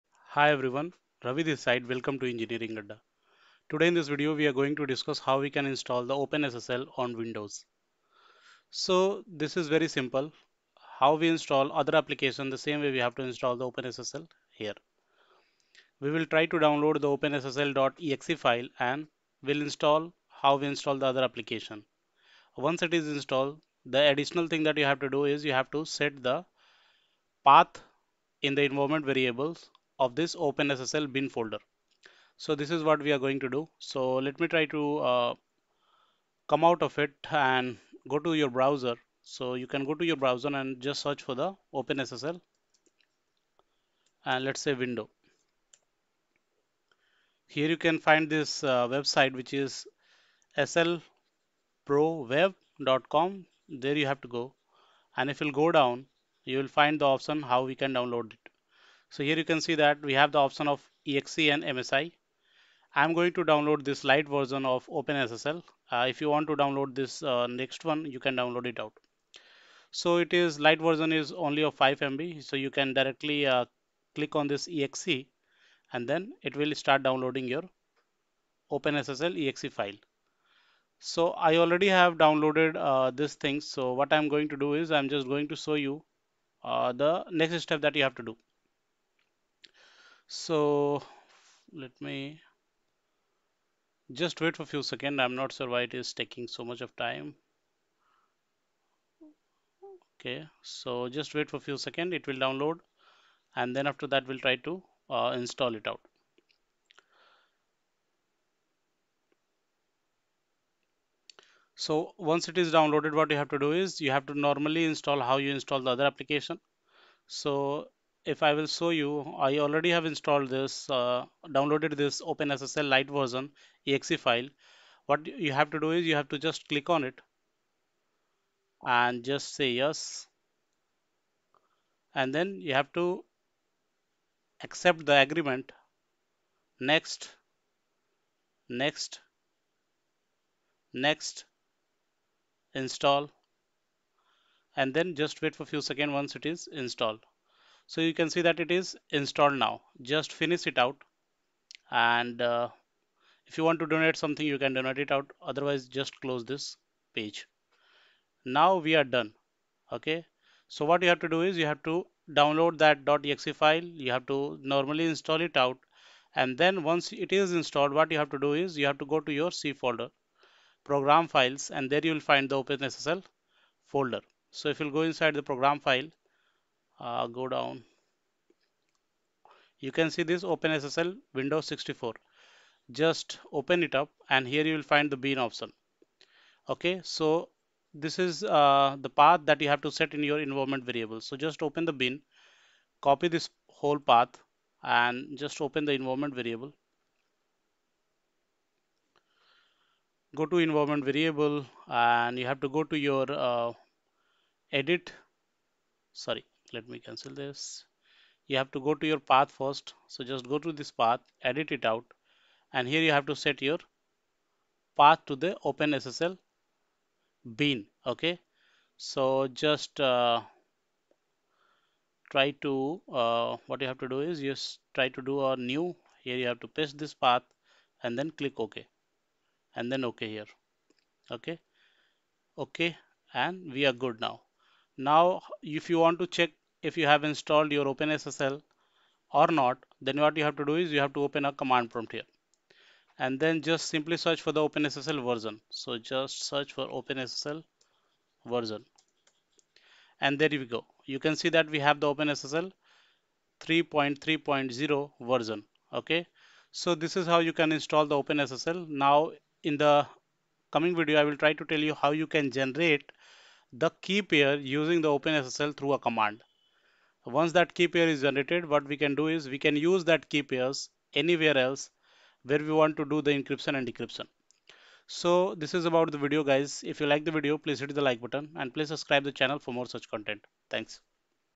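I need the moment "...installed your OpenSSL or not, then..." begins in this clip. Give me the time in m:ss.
3:57.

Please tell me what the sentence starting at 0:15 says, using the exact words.
We will try to download the OpenSSL.exe file and will install how we install the other application.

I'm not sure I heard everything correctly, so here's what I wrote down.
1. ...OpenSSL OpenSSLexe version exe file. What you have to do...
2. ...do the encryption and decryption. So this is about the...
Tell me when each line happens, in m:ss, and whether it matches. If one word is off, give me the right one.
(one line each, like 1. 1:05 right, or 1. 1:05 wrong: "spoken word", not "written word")
1. 2:02 wrong: "Lite", not "OpenSSLexe"
2. 4:33 right.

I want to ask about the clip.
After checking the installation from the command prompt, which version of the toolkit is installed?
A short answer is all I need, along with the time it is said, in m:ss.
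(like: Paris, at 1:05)
3.3.0, at 4:13.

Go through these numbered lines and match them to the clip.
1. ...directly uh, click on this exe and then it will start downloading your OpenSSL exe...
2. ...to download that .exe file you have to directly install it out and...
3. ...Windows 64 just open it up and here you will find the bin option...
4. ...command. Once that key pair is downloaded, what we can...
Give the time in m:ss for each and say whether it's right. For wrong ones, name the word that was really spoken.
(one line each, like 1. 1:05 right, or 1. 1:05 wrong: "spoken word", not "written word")
1. 1:12 right
2. 2:41 wrong: "normally", not "directly"
3. 3:01 right
4. 4:25 wrong: "generated", not "downloaded".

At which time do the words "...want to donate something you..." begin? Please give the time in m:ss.
2:33.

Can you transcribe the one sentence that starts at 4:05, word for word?
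So just search for OpenSSL version.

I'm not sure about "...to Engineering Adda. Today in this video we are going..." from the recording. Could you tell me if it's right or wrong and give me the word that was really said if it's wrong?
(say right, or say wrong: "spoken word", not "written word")
right.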